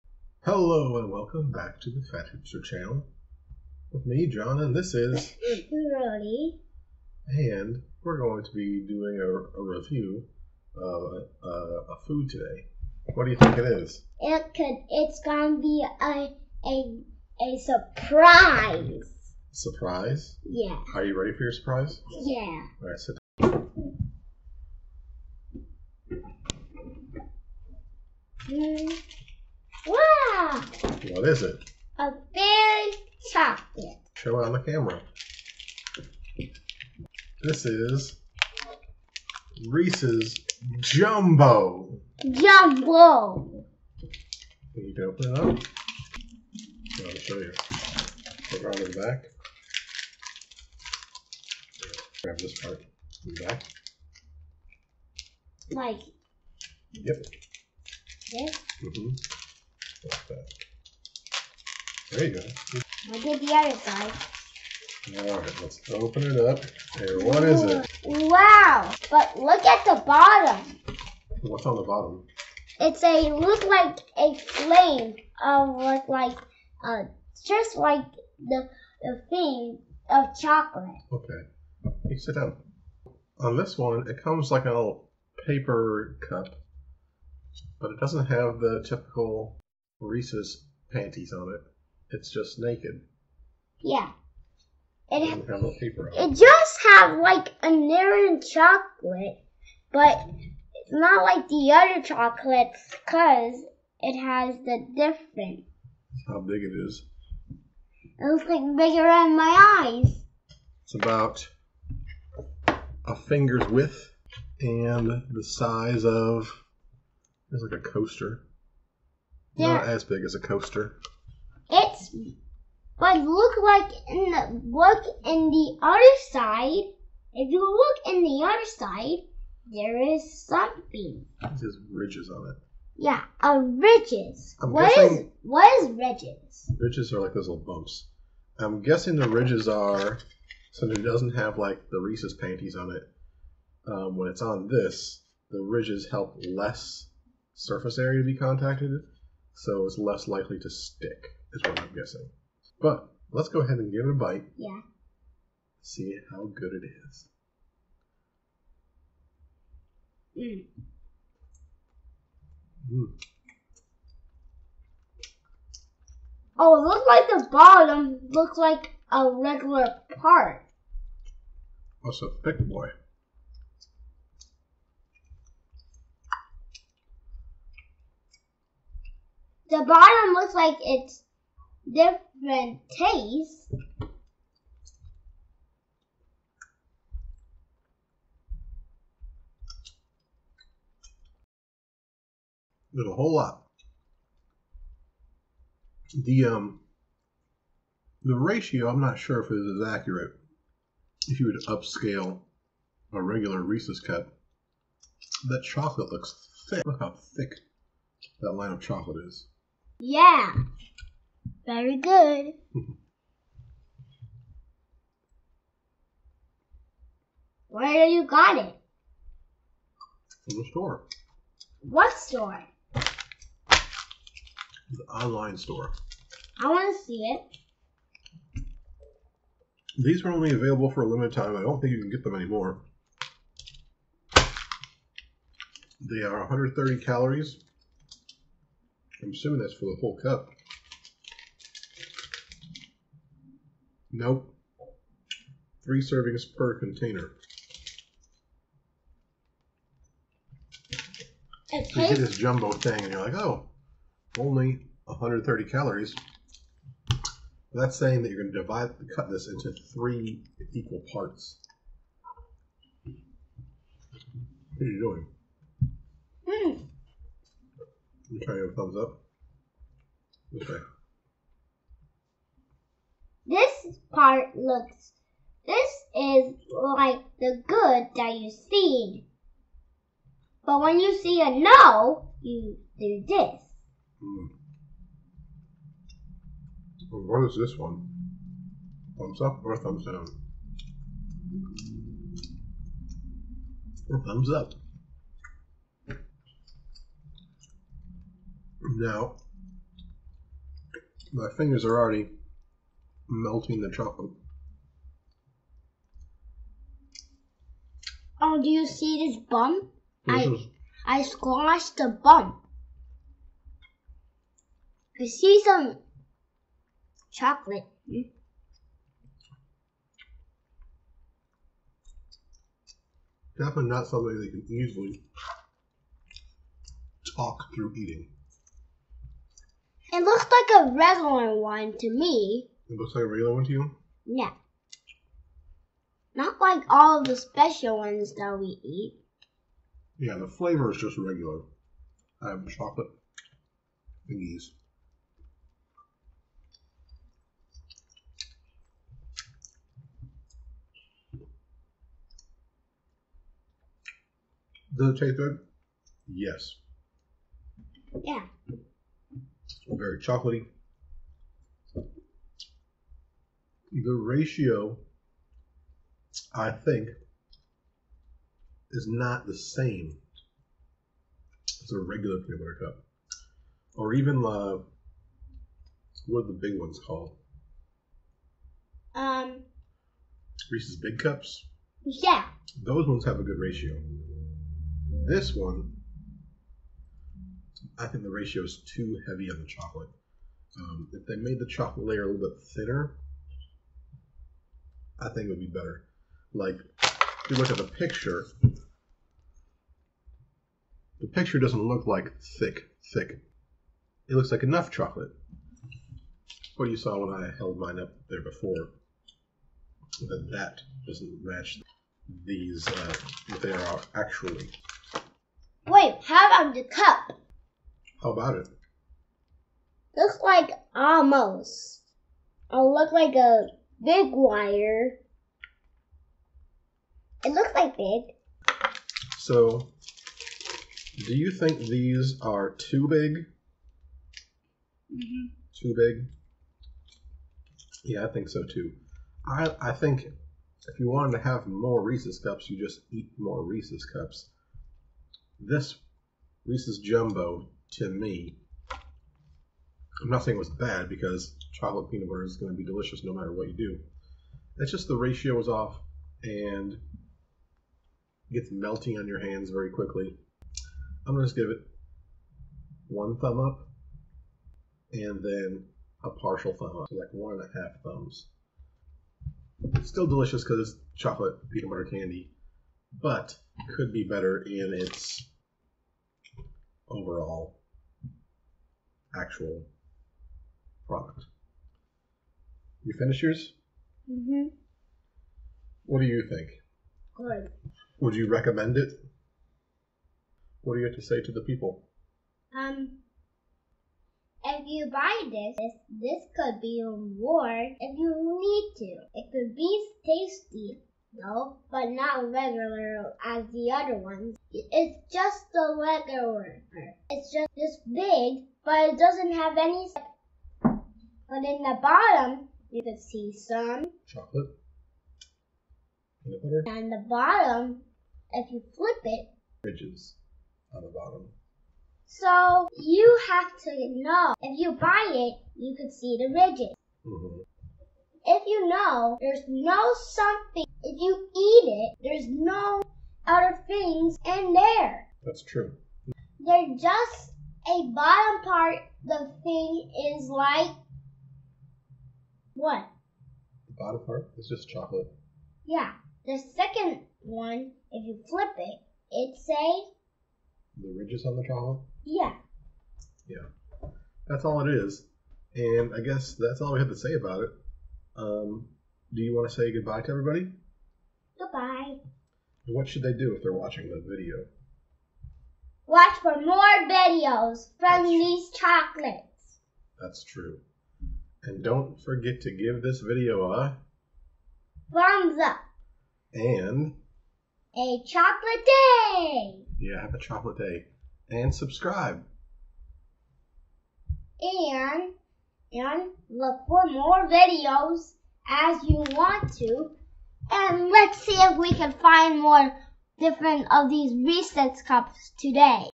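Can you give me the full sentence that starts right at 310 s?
This I I squashed the bump.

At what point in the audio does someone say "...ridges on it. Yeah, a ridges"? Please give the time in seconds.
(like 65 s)
131 s.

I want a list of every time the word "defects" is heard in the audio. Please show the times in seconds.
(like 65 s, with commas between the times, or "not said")
not said.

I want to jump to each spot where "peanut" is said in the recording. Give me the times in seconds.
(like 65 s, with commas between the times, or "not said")
372 s, 452 s, 471 s, 516 s.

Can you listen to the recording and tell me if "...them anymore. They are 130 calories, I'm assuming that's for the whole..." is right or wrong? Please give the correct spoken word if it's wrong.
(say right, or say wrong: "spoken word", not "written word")
right.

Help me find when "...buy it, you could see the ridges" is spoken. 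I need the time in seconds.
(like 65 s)
524 s.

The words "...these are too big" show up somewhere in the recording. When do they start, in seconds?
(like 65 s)
431 s.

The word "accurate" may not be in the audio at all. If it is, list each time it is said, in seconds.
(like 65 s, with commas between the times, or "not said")
199 s.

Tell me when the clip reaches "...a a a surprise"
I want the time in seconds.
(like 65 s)
16 s.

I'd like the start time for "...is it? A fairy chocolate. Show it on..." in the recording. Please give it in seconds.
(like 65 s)
31 s.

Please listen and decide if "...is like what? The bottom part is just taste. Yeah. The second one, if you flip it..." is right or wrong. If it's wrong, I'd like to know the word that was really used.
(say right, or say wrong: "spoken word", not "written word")
wrong: "chocolate", not "taste".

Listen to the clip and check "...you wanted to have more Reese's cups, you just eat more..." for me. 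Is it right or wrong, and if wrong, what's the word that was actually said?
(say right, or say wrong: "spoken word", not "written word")
right.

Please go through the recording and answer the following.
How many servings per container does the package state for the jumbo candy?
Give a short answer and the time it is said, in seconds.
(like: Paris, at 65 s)
3, at 245 s.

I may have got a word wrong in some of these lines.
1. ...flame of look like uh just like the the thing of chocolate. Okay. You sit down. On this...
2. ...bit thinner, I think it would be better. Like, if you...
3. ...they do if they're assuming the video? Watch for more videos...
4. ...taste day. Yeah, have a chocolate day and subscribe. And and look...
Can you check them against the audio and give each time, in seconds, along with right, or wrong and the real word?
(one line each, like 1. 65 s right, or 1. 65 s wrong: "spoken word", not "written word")
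1. 74 s right
2. 392 s right
3. 563 s wrong: "watching", not "assuming"
4. 578 s wrong: "chocolate", not "taste".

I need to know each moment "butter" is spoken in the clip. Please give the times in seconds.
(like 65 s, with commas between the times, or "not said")
372 s, 452 s, 471 s, 516 s.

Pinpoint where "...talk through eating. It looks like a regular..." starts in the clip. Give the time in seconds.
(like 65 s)
327 s.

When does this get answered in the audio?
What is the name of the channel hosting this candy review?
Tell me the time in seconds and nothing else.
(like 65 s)
2 s.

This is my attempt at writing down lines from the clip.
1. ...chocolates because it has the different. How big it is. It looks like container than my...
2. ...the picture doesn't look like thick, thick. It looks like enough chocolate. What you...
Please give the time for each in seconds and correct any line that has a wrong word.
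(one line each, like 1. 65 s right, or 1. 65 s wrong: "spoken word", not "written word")
1. 102 s wrong: "bigger", not "container"
2. 401 s right.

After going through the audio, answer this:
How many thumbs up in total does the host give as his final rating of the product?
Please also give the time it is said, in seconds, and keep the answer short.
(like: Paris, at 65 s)
1.5, at 467 s.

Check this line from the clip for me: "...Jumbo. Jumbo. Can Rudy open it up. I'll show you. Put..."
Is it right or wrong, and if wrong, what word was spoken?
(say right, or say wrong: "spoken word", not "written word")
wrong: "You", not "Rudy".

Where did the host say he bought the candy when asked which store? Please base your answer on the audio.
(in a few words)
the online store.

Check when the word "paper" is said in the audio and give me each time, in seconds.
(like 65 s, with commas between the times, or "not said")
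85 s, 95 s.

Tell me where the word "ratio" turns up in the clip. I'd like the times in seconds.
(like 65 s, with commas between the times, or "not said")
198 s, 364 s, 383 s, 388 s, 455 s.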